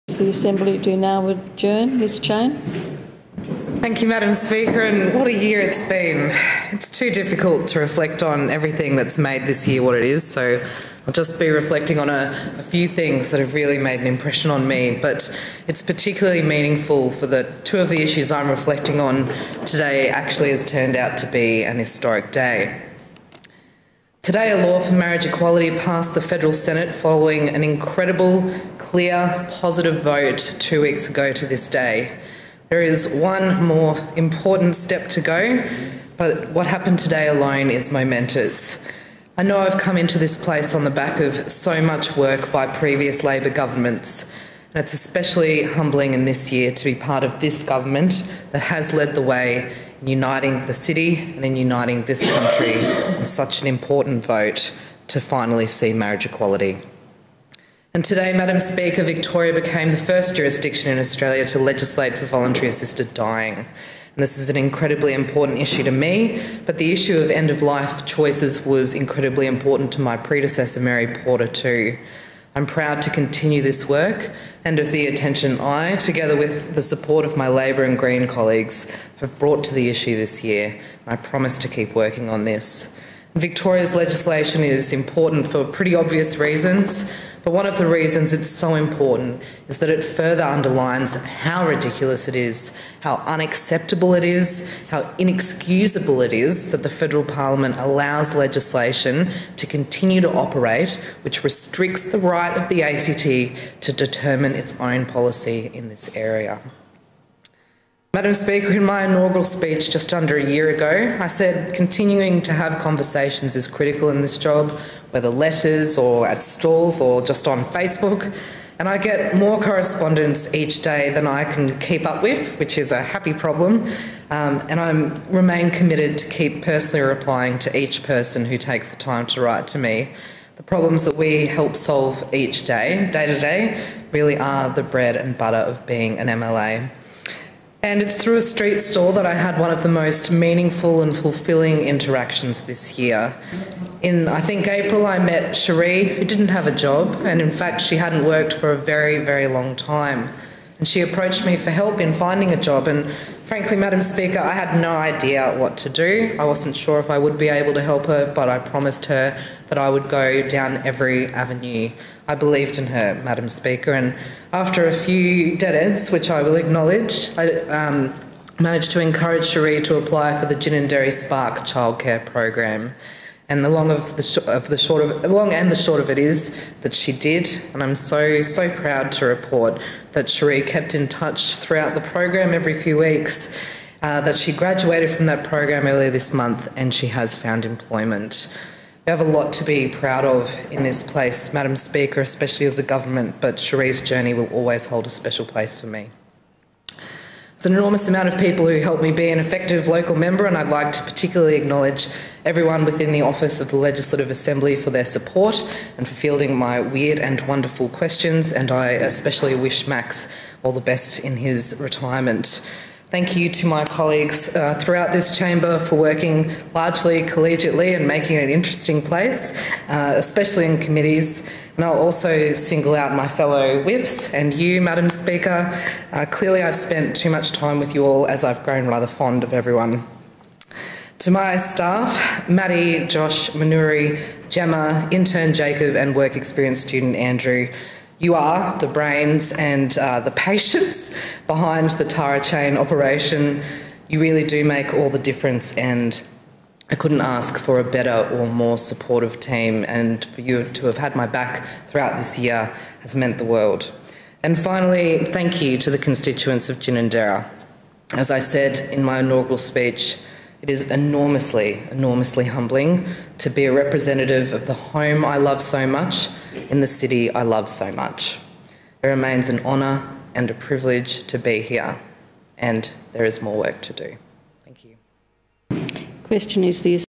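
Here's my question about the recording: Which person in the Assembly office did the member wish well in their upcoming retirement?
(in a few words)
Max.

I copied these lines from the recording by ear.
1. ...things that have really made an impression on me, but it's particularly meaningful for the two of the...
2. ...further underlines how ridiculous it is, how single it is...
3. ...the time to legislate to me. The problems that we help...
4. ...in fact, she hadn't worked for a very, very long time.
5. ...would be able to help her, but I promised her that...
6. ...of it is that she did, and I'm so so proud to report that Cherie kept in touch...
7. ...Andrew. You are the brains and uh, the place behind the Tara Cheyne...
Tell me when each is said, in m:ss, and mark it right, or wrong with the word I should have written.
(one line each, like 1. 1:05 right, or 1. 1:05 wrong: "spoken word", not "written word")
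1. 0:12 right
2. 1:30 wrong: "unacceptable", not "single"
3. 2:08 wrong: "write", not "legislate"
4. 2:27 right
5. 2:37 right
6. 2:55 right
7. 3:57 wrong: "patience", not "place".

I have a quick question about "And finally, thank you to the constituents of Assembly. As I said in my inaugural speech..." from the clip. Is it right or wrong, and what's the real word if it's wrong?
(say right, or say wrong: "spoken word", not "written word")
wrong: "Ginninderra", not "Assembly".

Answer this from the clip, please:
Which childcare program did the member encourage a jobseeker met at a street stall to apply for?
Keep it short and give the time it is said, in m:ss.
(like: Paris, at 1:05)
Ginninderra Spark, at 2:50.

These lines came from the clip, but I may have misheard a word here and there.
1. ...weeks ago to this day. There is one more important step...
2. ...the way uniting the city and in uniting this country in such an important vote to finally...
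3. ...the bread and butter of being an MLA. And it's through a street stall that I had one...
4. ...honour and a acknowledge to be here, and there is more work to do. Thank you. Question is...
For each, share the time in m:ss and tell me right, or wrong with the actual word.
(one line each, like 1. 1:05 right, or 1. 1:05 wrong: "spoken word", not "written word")
1. 0:30 right
2. 0:49 right
3. 2:14 right
4. 4:29 wrong: "privilege", not "acknowledge".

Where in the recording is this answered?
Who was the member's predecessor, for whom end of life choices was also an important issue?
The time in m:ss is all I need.
1:10.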